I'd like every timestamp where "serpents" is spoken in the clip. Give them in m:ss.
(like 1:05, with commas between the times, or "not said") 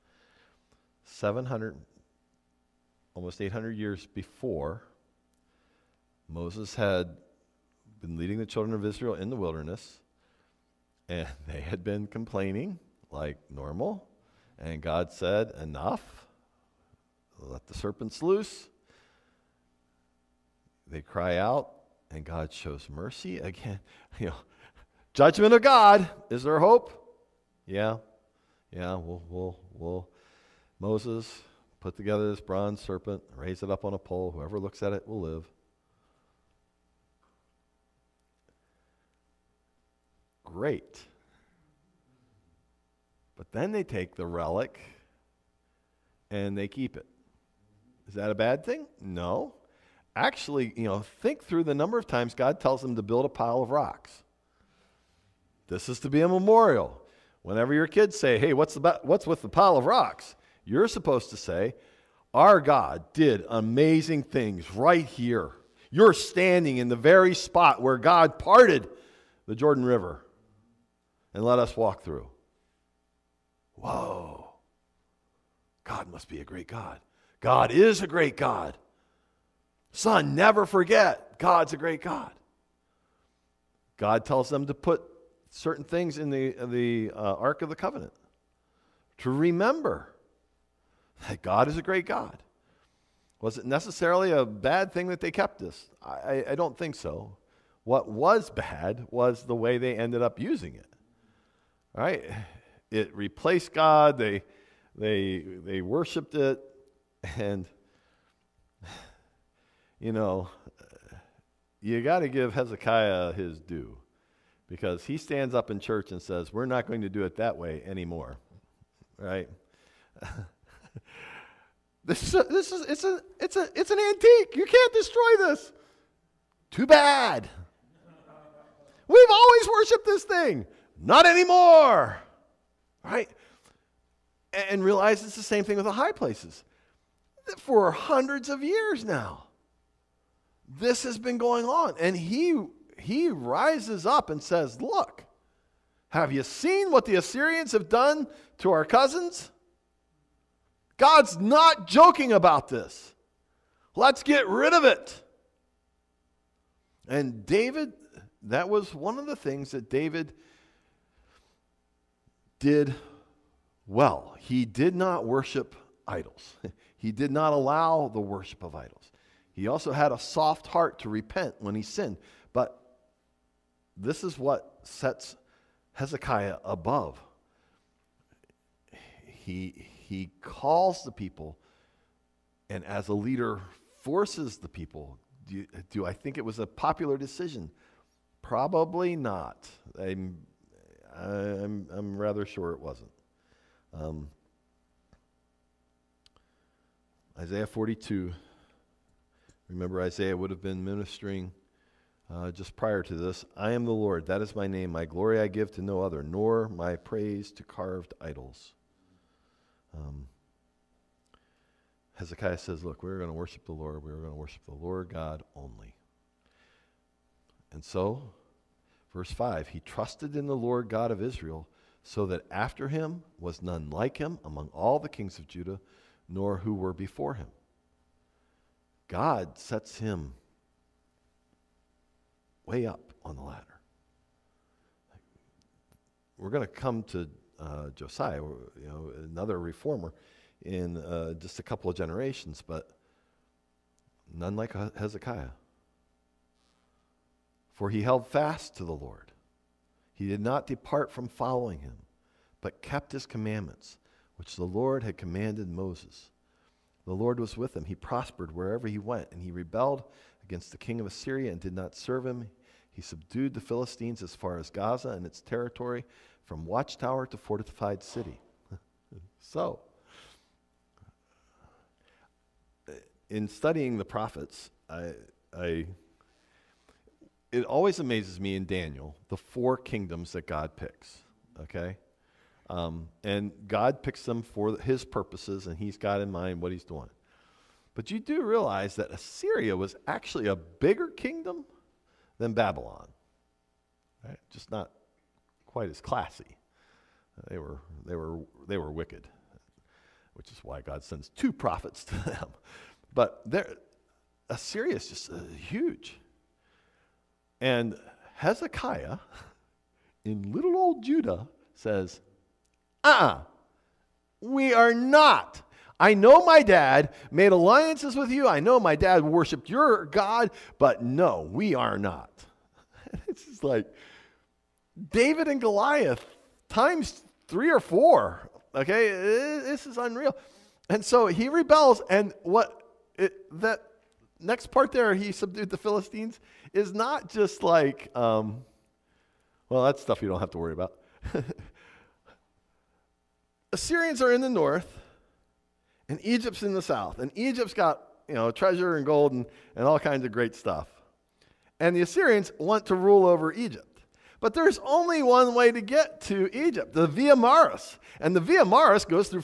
0:17, 0:32.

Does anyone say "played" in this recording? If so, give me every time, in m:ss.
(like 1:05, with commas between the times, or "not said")
not said.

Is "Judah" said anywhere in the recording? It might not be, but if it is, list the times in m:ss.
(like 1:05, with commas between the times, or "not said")
3:45, 5:11.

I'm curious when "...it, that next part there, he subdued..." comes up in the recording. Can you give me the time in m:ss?
5:33.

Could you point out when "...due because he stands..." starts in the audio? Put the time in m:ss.
1:53.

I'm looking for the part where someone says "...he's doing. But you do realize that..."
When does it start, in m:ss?
4:46.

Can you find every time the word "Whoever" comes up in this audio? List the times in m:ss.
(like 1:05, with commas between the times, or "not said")
0:34.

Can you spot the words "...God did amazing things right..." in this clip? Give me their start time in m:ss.
1:02.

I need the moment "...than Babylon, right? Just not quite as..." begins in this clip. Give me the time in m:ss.
4:52.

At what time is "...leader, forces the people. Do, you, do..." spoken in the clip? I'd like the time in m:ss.
3:03.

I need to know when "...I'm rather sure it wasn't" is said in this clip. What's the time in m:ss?
3:11.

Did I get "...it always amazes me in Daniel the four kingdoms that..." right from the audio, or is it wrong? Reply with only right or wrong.
right.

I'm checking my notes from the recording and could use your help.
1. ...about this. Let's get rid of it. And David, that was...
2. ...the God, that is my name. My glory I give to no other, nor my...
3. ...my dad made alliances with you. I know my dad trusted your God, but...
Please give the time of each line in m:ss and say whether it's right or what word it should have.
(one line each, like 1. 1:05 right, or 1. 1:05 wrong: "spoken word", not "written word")
1. 2:32 right
2. 3:23 wrong: "Lord", not "God"
3. 5:16 wrong: "worshiped", not "trusted".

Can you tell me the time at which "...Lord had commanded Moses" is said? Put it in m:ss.
4:14.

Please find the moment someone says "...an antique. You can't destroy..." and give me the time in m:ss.
2:03.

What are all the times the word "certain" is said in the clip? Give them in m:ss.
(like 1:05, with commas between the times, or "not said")
1:25.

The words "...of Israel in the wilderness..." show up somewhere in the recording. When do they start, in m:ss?
0:08.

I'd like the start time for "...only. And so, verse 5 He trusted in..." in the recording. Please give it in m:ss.
3:35.